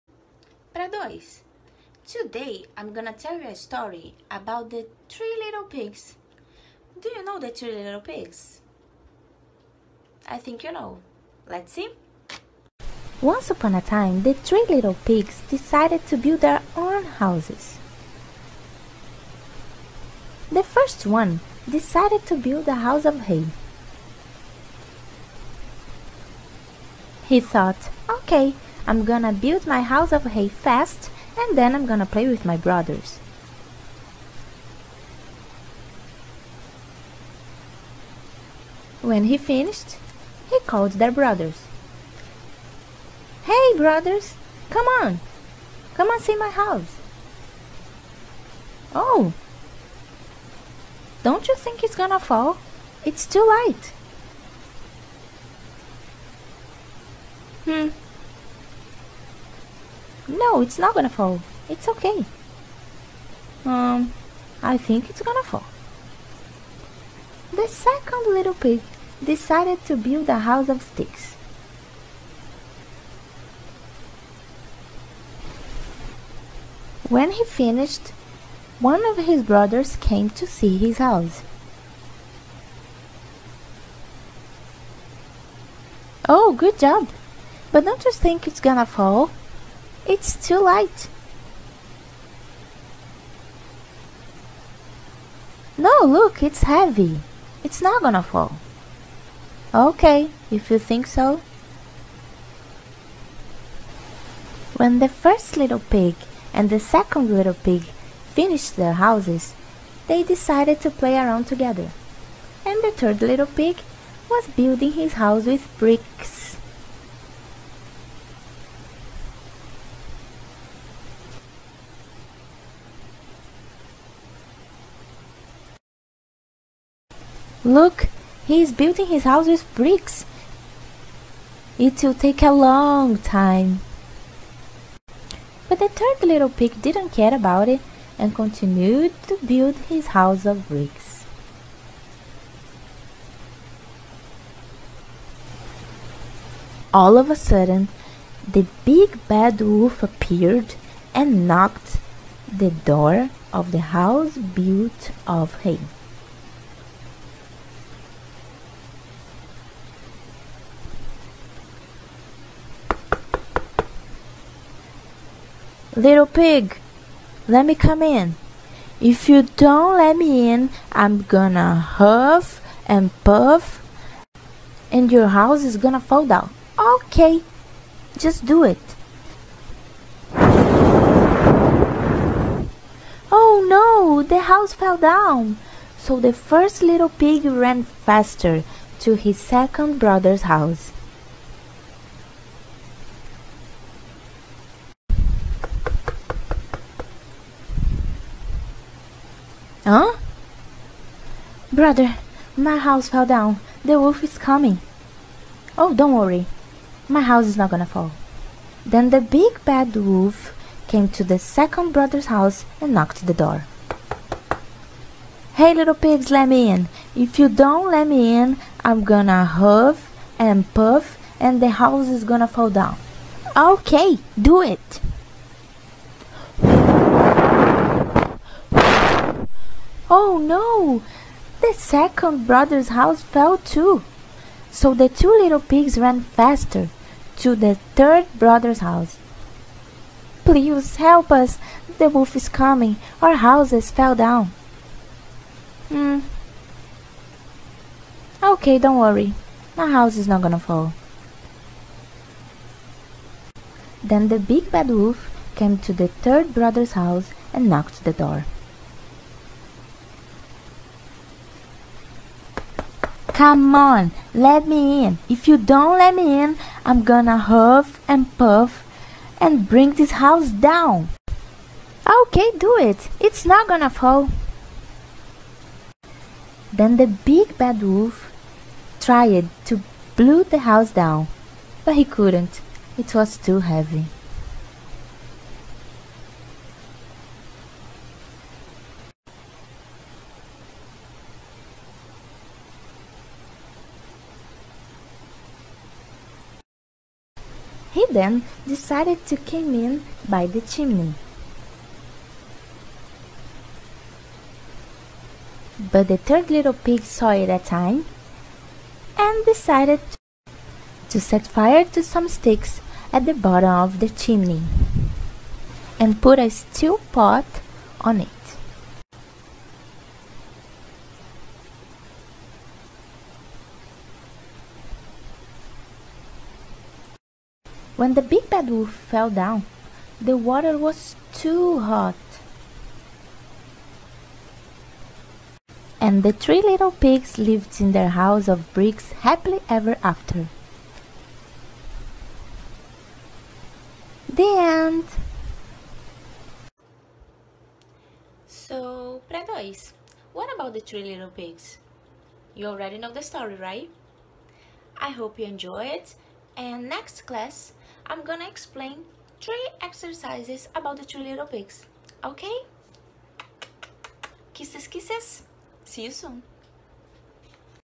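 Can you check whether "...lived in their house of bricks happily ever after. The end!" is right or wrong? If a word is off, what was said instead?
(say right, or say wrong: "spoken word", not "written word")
right.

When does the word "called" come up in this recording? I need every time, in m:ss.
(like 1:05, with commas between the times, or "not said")
0:40.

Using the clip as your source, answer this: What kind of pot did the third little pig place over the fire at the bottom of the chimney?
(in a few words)
steel pot.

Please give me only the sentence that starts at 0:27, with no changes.
He thought, okay, I'm gonna build my house of hay fast and then I'm gonna play with my brothers.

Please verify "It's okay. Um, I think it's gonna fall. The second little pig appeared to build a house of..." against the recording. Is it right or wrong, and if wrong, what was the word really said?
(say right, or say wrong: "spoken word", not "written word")
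wrong: "decided", not "appeared".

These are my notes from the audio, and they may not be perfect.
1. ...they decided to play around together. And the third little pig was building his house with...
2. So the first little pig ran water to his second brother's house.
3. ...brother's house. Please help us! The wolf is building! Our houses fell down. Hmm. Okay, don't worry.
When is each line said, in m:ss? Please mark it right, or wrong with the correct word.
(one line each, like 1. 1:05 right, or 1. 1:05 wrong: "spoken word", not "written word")
1. 1:50 right
2. 3:05 wrong: "faster", not "water"
3. 3:58 wrong: "coming", not "building".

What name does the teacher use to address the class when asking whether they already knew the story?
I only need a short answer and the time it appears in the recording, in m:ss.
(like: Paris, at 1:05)
Pré dois, at 5:49.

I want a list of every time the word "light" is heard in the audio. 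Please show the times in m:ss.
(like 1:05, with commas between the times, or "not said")
0:53, 1:30.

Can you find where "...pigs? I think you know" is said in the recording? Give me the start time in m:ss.
0:08.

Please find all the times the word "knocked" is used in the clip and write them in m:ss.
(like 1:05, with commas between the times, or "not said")
2:31, 3:32, 4:17.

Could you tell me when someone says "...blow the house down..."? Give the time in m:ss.
4:40.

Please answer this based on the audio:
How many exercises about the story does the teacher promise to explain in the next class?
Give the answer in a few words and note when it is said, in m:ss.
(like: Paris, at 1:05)
3, at 5:59.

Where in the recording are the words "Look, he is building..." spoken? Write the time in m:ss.
2:07.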